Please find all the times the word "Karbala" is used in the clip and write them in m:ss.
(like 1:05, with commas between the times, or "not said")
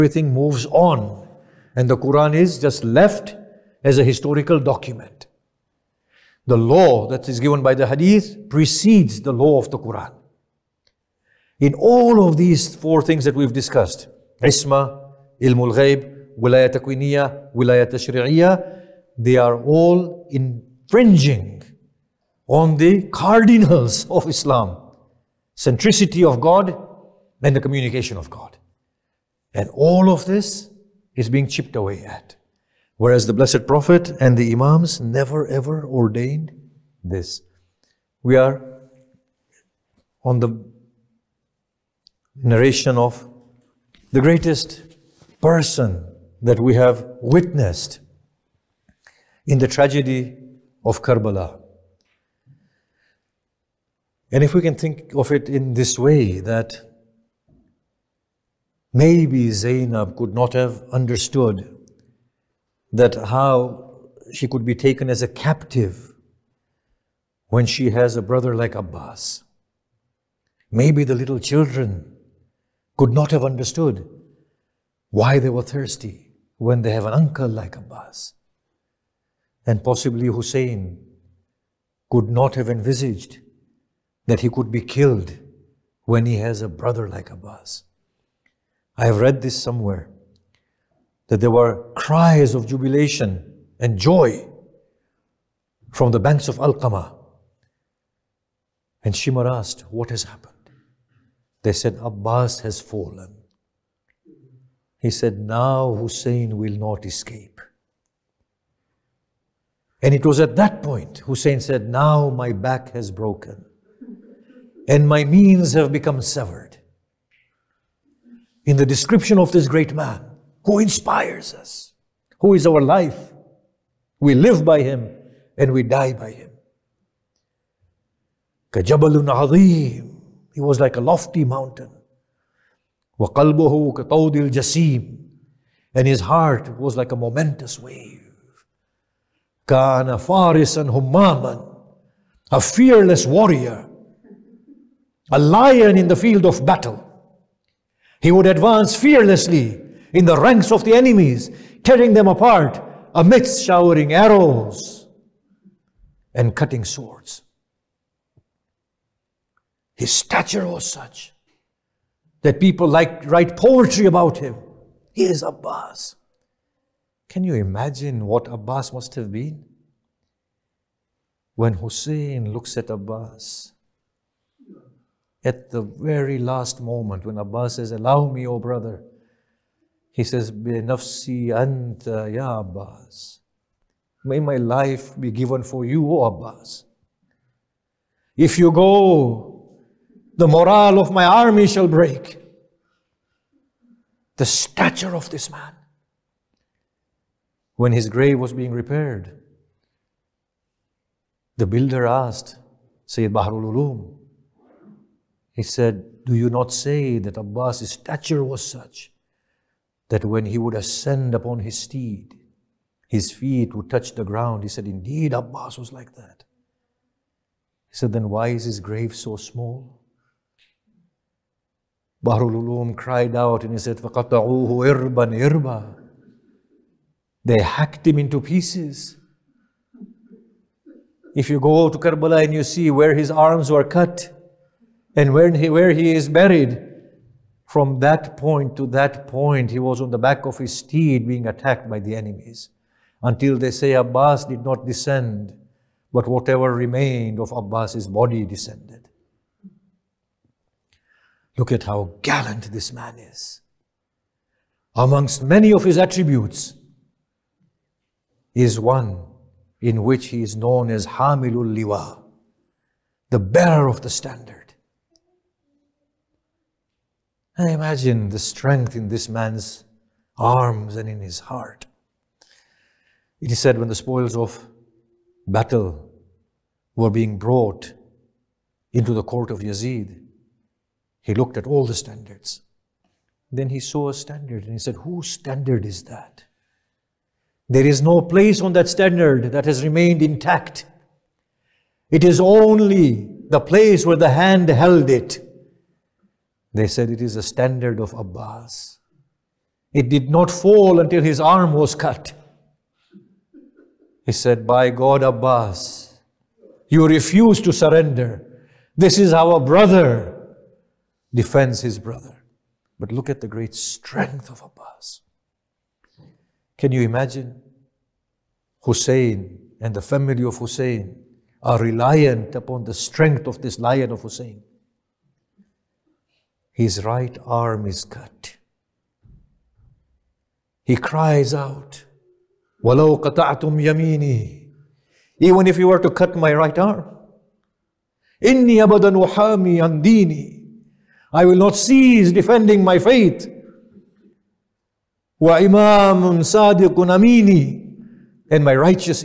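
0:51, 3:51.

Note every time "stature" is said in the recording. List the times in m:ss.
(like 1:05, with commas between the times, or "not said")
2:40, 3:14, 3:27.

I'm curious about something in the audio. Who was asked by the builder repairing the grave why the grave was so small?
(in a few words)
Sayyid Baharul Ulum.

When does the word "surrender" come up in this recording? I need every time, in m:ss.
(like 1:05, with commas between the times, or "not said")
5:07.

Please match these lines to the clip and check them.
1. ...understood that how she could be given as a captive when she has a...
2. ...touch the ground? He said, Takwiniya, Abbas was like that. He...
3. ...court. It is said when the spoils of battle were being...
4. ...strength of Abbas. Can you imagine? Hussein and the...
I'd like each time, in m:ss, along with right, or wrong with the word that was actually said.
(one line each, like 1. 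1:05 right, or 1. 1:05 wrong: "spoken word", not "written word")
1. 1:00 wrong: "taken", not "given"
2. 3:33 wrong: "Indeed", not "Takwiniya"
3. 4:31 wrong: "heart", not "court"
4. 5:13 right.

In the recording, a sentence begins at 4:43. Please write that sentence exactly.
Then he saw a standard and he said, Whose standard is that?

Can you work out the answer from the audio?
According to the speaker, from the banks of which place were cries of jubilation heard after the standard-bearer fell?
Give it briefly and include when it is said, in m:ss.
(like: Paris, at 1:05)
Al-Qama, at 1:36.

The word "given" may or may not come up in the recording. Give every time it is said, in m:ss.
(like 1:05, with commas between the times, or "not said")
0:07, 3:05.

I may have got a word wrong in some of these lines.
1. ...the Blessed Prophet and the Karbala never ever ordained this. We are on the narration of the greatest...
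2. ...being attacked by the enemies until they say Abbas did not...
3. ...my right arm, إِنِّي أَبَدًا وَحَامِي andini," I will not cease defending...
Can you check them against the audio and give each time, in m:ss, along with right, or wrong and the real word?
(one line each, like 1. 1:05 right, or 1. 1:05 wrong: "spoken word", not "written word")
1. 0:33 wrong: "Imams", not "Karbala"
2. 4:01 right
3. 5:36 right.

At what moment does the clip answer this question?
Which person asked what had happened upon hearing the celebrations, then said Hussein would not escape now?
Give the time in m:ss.
1:39.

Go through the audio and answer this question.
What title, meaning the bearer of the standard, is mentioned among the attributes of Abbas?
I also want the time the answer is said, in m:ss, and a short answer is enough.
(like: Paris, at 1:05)
Hamilul Liwa, at 4:21.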